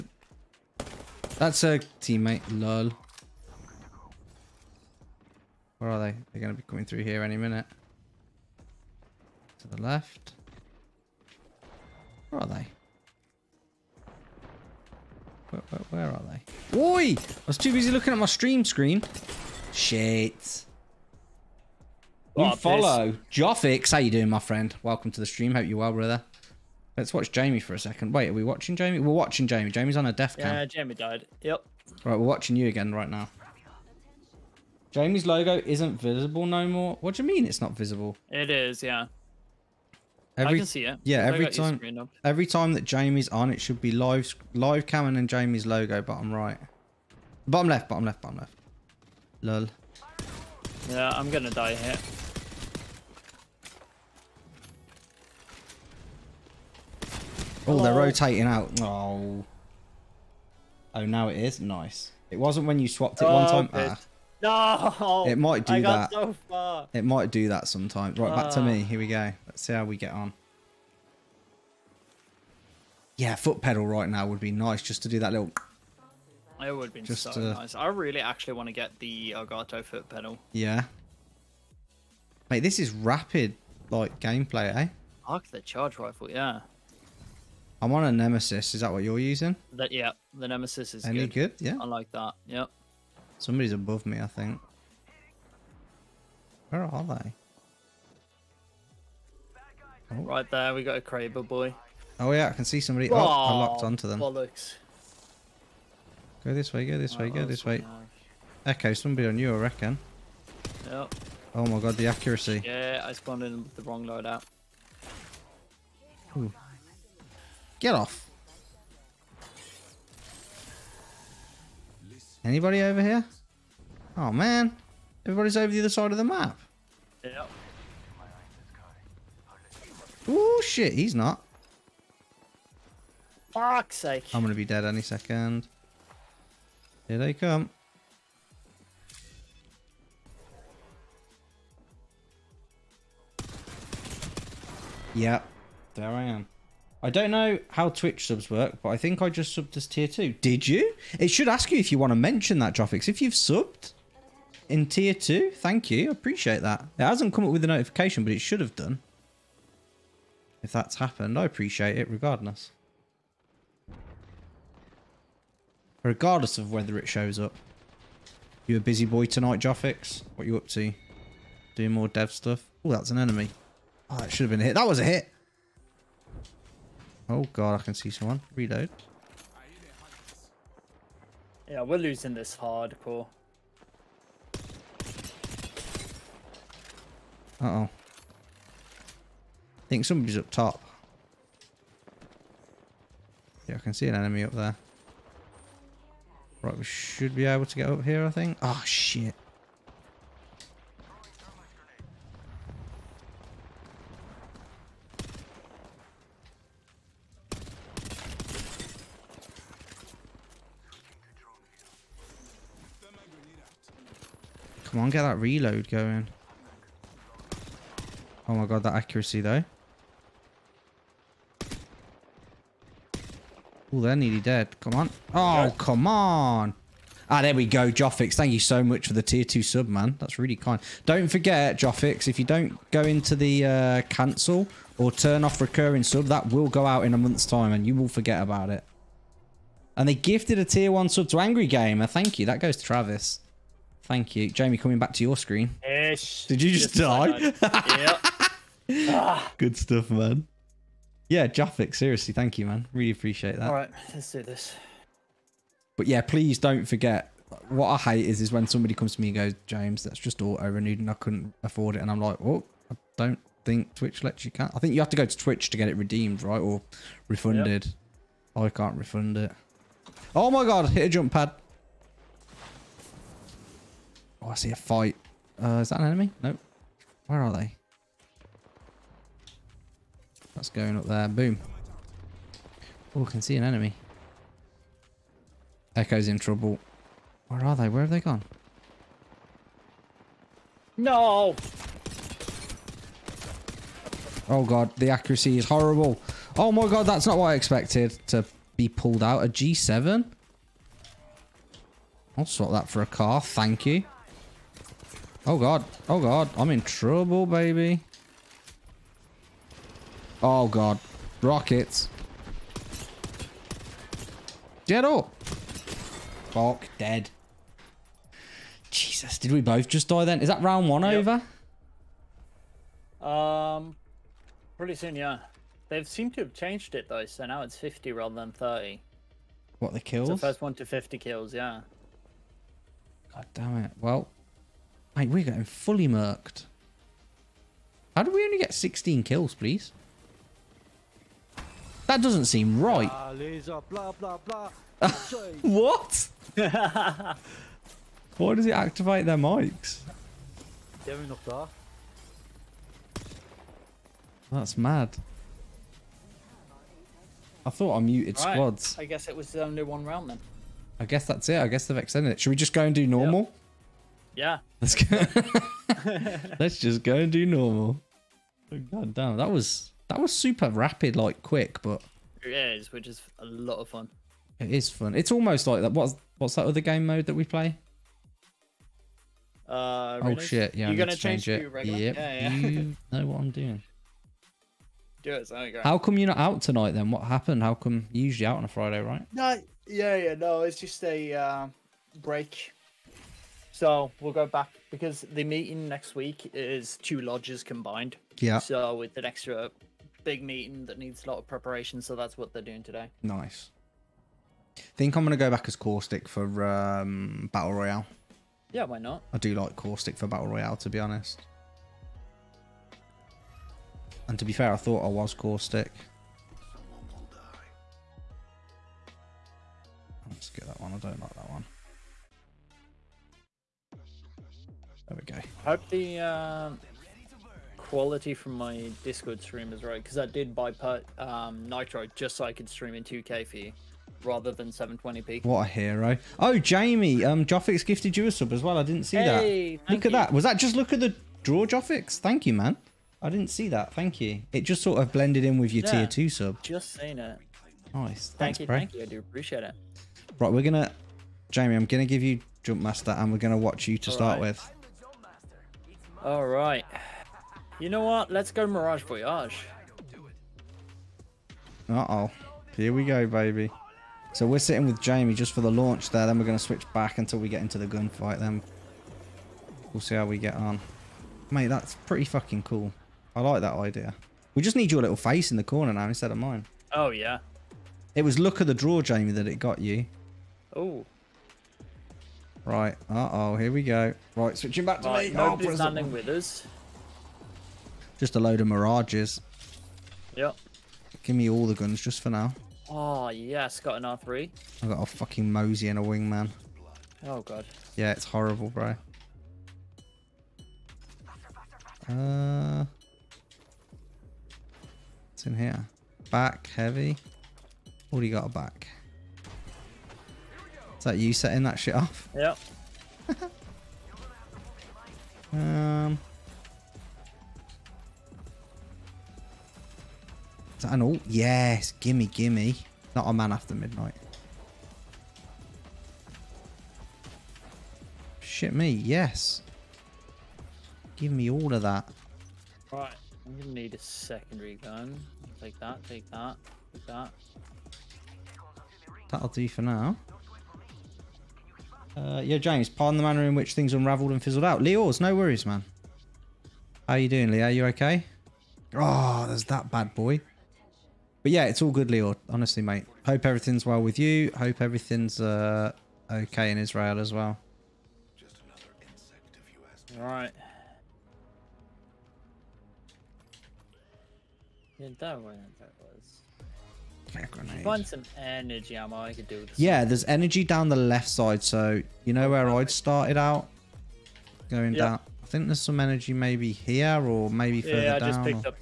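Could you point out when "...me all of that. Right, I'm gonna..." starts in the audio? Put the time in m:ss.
8:51.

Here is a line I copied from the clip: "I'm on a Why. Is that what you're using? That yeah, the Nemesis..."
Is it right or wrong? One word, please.
wrong.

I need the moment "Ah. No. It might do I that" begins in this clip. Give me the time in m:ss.
1:04.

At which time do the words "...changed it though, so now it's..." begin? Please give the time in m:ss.
5:26.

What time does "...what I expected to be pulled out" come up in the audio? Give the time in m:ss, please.
4:57.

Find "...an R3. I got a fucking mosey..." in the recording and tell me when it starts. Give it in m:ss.
8:13.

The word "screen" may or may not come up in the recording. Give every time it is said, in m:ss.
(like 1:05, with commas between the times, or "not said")
0:18, 4:05.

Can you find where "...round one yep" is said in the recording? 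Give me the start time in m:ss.
5:20.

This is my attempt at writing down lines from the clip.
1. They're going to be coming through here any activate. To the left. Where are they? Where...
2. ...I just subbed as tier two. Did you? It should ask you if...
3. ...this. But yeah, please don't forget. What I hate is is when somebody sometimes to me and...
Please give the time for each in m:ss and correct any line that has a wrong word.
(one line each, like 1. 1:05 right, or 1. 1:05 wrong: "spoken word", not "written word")
1. 0:06 wrong: "minute", not "activate"
2. 2:29 right
3. 4:14 wrong: "comes", not "sometimes".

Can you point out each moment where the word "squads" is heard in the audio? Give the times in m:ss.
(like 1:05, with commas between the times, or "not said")
5:58.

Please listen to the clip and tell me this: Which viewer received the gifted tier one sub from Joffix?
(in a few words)
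Angry Gamer.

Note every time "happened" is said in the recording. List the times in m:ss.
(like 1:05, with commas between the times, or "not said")
2:40, 6:27.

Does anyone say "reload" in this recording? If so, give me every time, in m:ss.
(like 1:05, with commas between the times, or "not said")
2:58, 3:35.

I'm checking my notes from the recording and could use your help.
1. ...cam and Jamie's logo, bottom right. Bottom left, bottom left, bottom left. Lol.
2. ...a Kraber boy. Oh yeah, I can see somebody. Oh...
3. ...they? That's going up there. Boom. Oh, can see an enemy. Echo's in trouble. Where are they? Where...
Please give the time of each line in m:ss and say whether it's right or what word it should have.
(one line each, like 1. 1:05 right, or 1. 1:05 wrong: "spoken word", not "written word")
1. 0:44 right
2. 1:40 right
3. 4:37 right.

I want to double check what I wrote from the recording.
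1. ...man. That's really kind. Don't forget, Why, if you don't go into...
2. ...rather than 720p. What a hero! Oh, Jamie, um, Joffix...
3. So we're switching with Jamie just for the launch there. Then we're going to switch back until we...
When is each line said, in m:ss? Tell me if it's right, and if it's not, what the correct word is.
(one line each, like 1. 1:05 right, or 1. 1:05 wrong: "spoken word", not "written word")
1. 3:49 wrong: "Joffix", not "Why"
2. 7:14 right
3. 7:44 wrong: "sitting", not "switching".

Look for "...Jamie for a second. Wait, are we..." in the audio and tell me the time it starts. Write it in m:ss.
0:27.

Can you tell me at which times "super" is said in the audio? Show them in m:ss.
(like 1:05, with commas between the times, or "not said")
6:10.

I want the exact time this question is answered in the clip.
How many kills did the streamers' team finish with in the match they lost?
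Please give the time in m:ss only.
5:38.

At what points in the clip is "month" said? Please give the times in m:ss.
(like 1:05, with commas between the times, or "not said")
3:57.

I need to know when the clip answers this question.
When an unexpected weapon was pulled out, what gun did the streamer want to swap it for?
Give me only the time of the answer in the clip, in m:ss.
5:03.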